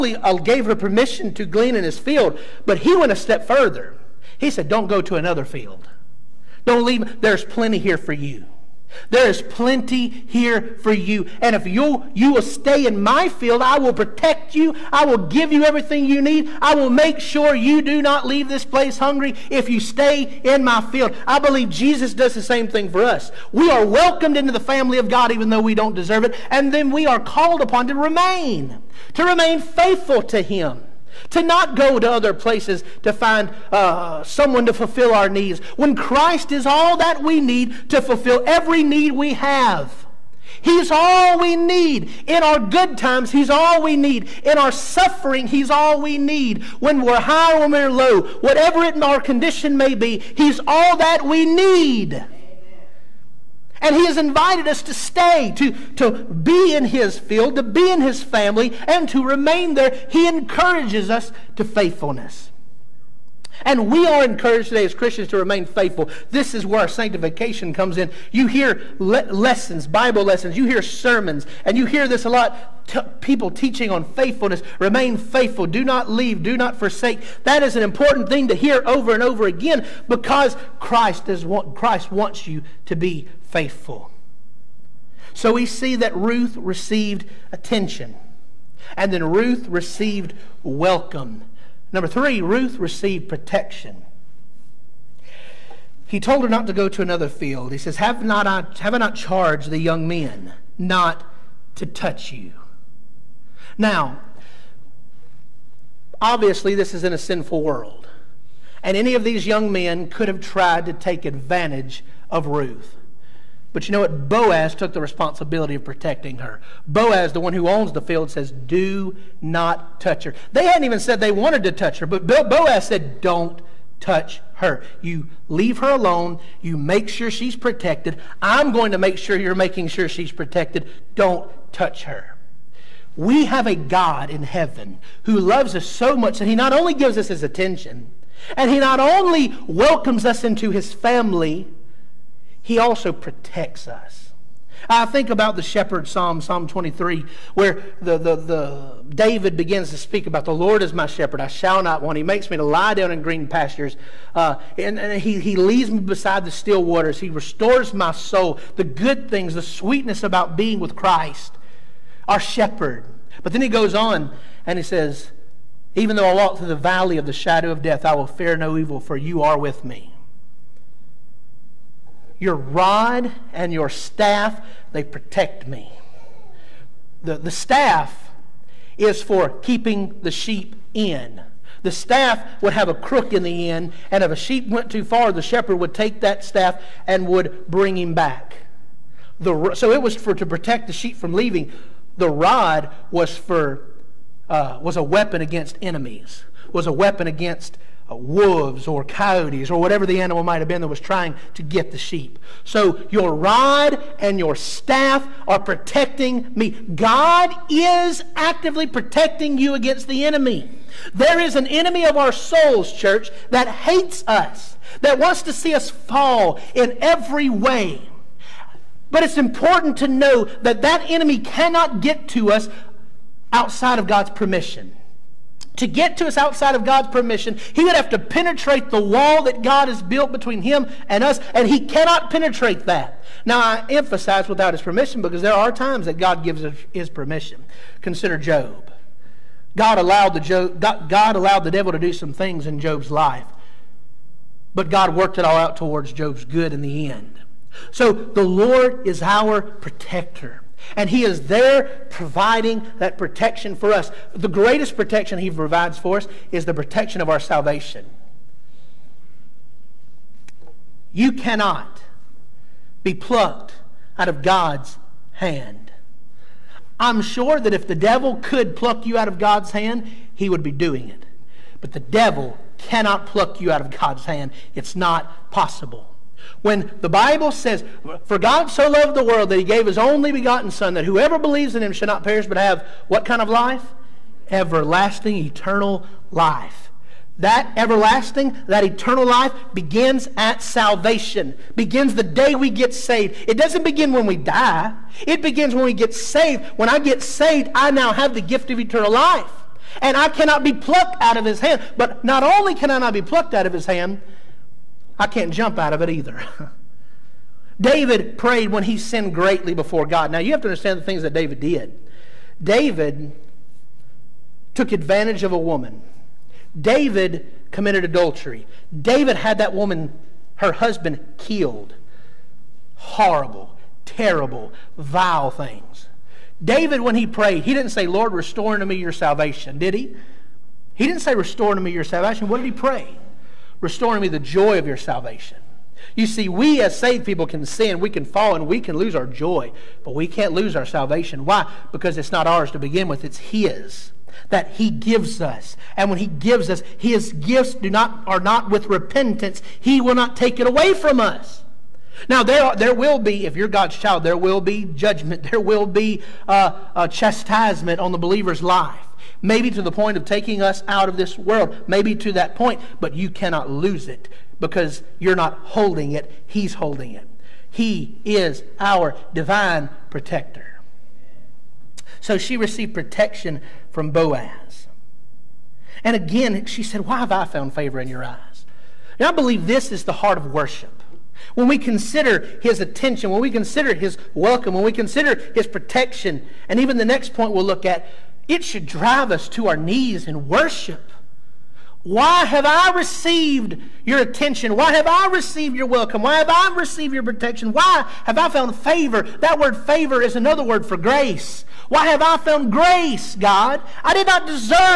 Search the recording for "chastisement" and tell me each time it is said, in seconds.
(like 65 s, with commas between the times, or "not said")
357 s.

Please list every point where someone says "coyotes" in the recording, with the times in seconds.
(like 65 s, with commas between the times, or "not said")
199 s.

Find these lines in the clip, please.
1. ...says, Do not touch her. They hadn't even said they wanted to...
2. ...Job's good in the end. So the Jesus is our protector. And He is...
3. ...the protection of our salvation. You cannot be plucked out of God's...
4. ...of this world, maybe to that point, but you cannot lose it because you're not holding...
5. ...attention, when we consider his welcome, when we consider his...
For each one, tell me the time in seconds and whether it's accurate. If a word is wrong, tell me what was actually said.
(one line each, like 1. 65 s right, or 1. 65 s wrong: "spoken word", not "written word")
1. 118 s right
2. 246 s wrong: "Lord", not "Jesus"
3. 256 s right
4. 361 s right
5. 382 s right.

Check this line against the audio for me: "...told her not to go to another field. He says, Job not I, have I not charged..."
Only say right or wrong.
wrong.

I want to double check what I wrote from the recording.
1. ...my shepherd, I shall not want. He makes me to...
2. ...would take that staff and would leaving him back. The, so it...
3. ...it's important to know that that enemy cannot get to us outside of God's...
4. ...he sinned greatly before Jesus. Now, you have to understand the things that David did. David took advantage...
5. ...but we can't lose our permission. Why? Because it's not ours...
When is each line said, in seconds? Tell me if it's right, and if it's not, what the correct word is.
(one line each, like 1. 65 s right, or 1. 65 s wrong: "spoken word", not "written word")
1. 150 s right
2. 185 s wrong: "bring", not "leaving"
3. 219 s right
4. 308 s wrong: "God", not "Jesus"
5. 340 s wrong: "salvation", not "permission".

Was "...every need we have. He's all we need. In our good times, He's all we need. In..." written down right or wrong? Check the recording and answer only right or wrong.
right.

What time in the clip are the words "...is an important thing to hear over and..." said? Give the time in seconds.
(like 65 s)
77 s.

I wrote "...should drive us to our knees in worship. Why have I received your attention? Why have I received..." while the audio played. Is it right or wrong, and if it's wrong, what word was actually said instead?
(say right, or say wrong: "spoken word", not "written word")
right.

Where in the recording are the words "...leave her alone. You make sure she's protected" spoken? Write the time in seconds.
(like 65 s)
125 s.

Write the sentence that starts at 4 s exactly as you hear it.
He said, Don't go to another field.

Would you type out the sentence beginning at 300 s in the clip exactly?
And I cannot be plucked out of his hand.